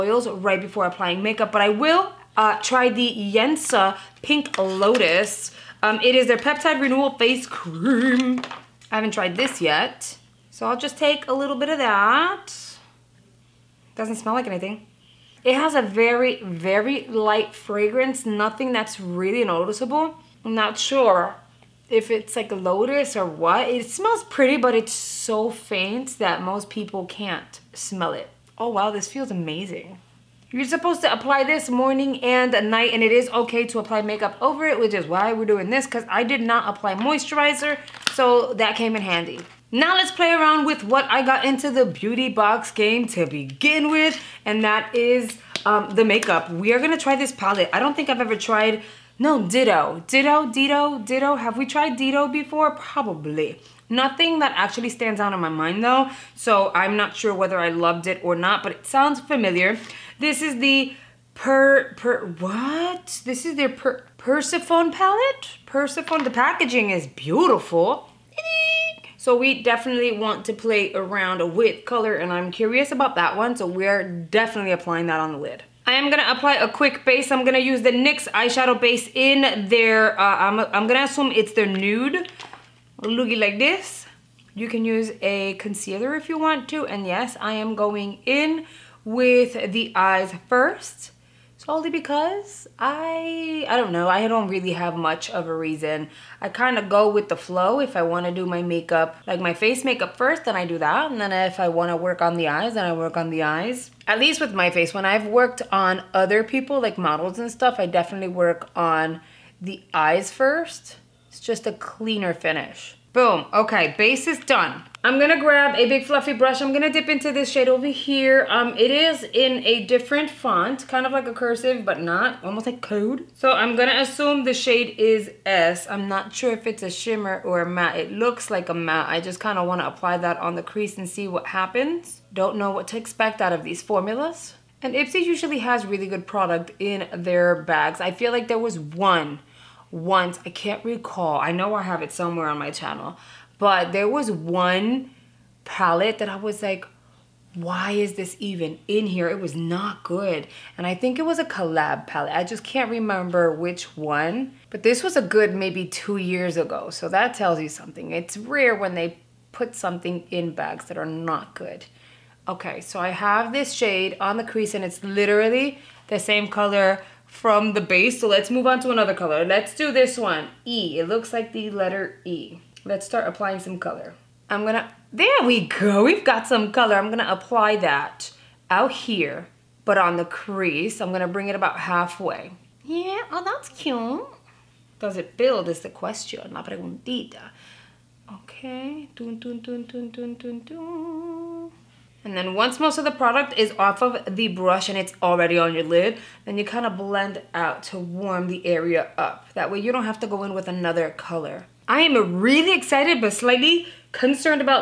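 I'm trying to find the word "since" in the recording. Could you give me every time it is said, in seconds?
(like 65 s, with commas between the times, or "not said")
not said.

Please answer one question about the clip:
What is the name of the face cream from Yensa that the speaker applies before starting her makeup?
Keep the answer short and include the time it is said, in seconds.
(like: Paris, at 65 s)
Peptide Renewal Face Cream, at 6 s.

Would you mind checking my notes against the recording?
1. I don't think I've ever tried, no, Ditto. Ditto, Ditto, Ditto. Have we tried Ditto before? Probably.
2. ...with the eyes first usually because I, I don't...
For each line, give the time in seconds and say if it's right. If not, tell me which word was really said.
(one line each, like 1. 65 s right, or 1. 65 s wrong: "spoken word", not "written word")
1. 47 s right
2. 89 s wrong: "solely", not "usually".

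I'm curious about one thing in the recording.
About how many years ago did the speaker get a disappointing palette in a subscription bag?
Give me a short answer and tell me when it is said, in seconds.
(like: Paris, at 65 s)
2 years, at 155 s.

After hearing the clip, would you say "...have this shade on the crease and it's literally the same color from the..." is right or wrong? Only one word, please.
right.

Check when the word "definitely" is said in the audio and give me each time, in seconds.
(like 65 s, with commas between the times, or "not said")
69 s, 74 s, 107 s.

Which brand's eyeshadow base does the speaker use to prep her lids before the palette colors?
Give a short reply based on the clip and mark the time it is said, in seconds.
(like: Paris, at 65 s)
NYX, at 77 s.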